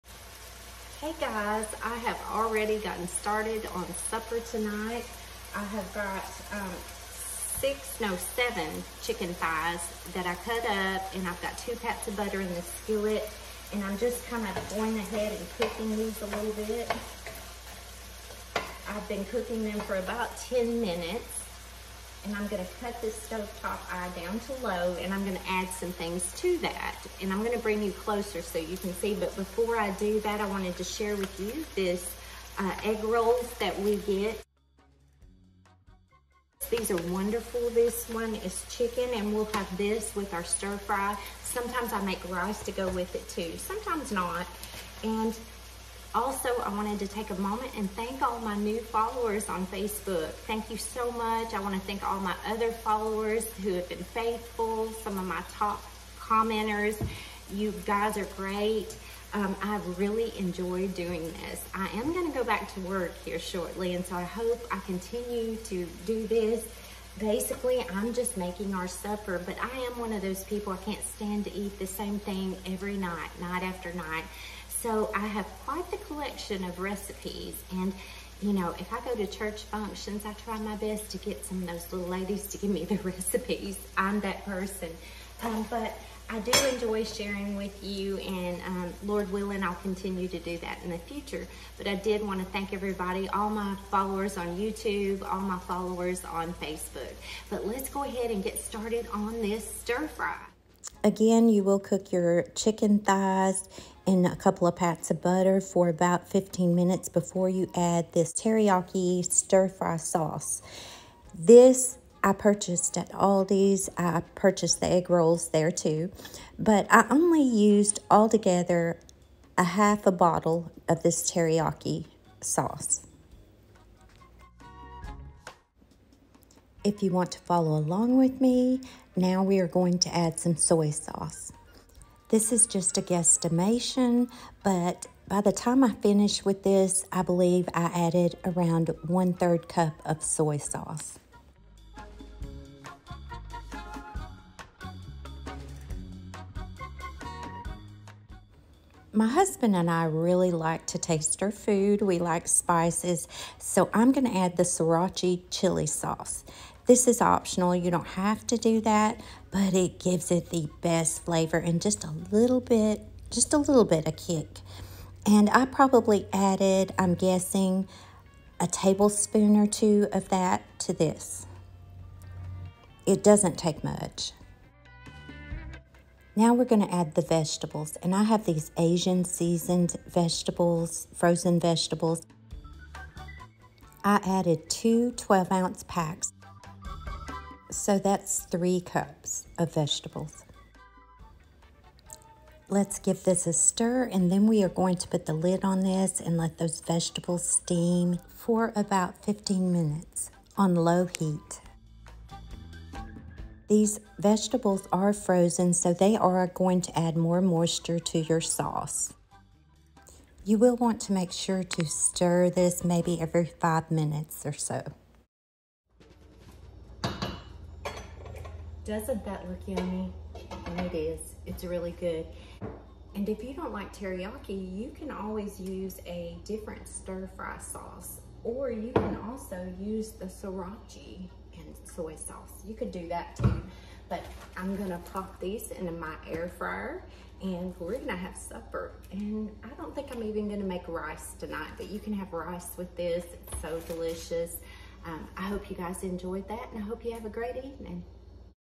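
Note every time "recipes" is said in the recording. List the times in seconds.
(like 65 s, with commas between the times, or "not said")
76 s, 83 s.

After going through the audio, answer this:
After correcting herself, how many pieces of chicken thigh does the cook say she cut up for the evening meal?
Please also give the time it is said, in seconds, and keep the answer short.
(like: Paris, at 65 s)
7, at 8 s.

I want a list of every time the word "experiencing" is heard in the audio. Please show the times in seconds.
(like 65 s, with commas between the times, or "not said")
not said.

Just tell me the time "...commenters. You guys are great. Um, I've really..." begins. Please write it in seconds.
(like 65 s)
56 s.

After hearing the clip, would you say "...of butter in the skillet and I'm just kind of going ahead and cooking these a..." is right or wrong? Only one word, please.
right.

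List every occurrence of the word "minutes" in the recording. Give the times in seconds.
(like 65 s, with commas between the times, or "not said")
20 s, 106 s, 199 s, 213 s.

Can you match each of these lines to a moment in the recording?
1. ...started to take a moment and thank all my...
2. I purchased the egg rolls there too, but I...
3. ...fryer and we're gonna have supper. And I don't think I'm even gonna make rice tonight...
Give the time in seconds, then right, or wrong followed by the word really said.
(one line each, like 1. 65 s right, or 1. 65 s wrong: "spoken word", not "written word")
1. 46 s wrong: "wanted", not "started"
2. 113 s right
3. 236 s right.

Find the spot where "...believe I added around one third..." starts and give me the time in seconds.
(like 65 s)
137 s.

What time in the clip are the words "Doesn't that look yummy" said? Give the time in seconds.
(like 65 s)
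218 s.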